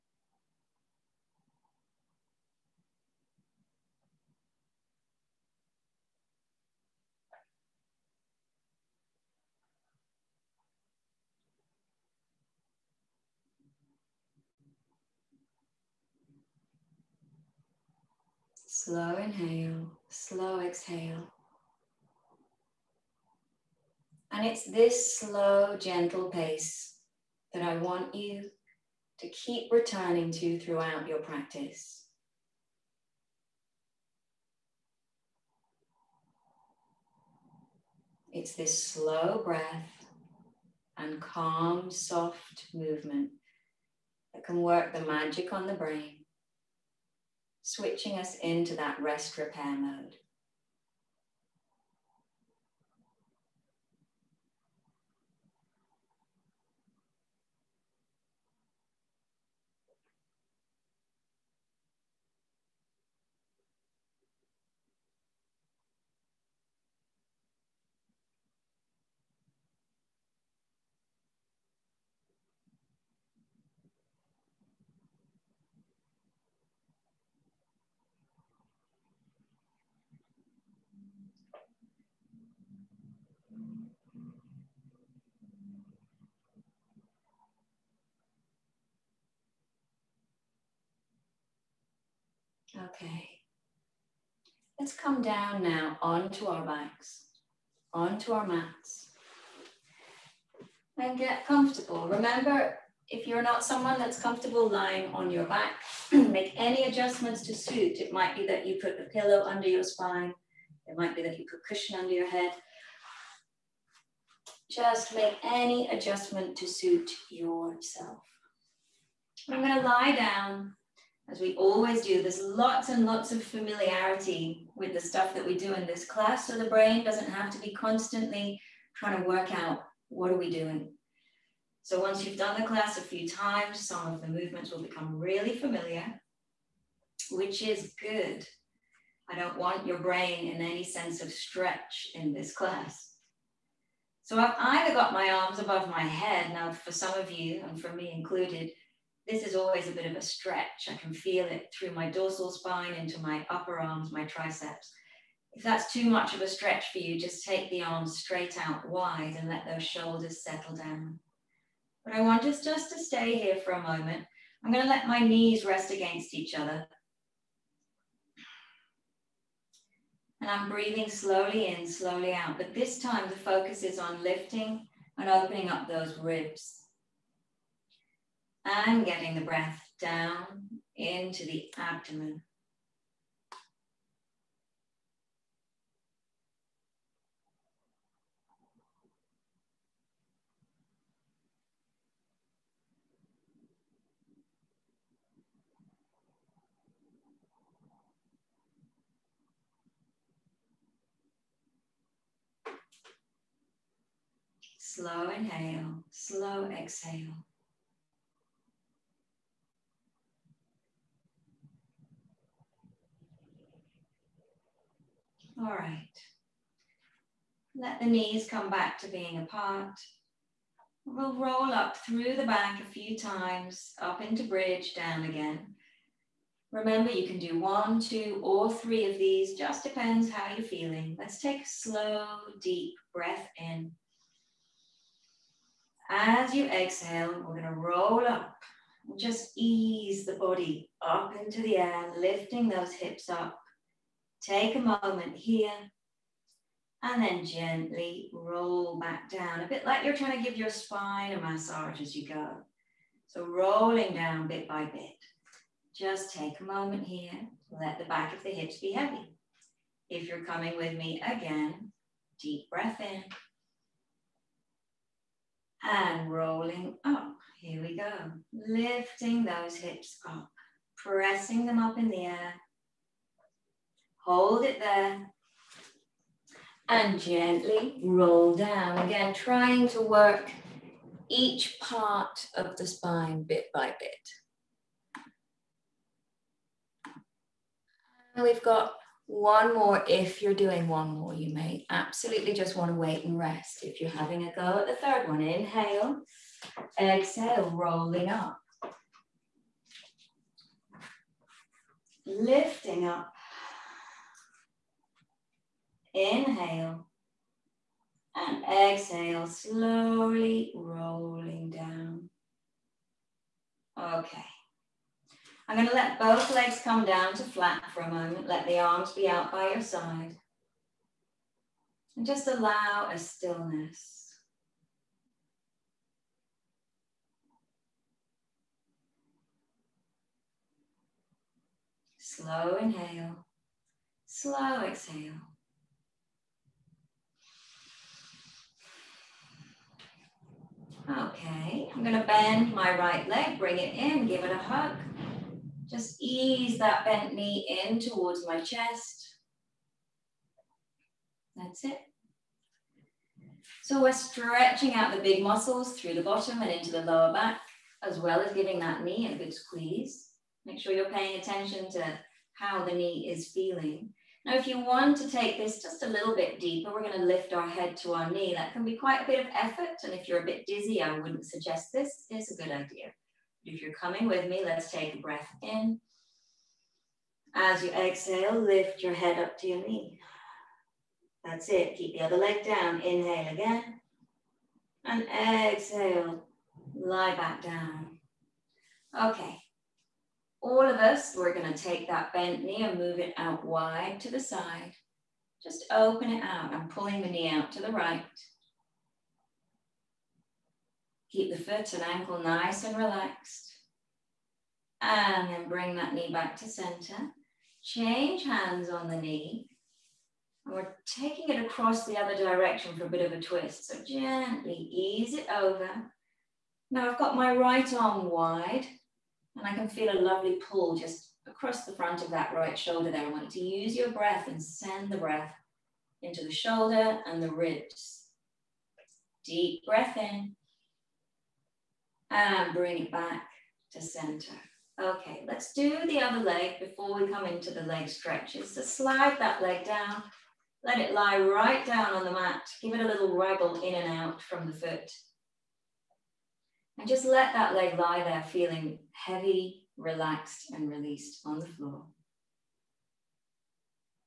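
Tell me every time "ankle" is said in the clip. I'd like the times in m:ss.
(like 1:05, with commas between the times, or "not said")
6:42.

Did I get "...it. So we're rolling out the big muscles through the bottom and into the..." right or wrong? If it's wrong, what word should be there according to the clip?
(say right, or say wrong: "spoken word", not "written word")
wrong: "stretching", not "rolling".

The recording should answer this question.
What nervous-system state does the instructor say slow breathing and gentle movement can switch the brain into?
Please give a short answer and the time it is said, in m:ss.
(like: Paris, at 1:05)
rest repair mode, at 0:49.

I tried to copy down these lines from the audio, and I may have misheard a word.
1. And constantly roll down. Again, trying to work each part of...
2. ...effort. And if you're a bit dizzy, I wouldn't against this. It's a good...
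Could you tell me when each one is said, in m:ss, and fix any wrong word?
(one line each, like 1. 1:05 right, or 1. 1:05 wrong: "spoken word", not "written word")
1. 4:36 wrong: "gently", not "constantly"
2. 6:09 wrong: "suggest", not "against".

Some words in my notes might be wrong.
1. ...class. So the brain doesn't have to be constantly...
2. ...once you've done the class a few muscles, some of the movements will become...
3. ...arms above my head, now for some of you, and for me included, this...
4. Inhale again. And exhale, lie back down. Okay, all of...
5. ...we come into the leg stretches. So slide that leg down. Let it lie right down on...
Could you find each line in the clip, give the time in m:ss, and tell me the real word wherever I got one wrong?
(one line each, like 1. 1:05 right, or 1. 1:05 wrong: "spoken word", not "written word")
1. 2:06 right
2. 2:12 wrong: "times", not "muscles"
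3. 2:25 right
4. 6:23 right
5. 7:17 right.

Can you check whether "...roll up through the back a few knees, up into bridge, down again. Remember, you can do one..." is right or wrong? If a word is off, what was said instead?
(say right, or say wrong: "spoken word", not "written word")
wrong: "times", not "knees".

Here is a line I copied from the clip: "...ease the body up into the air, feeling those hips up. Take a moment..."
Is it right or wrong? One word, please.
wrong.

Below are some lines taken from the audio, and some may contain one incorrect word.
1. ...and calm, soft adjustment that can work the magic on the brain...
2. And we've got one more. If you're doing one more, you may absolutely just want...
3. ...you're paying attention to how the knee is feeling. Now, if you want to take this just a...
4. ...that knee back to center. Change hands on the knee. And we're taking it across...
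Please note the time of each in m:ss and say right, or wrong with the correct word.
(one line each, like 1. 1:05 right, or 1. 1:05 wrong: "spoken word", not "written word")
1. 0:40 wrong: "movement", not "adjustment"
2. 4:48 right
3. 6:00 right
4. 6:45 right.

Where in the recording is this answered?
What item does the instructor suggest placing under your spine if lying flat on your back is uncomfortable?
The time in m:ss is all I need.
1:49.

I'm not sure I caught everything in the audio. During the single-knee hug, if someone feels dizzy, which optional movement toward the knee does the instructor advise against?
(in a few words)
lift your head.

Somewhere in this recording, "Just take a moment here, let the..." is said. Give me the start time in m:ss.
4:15.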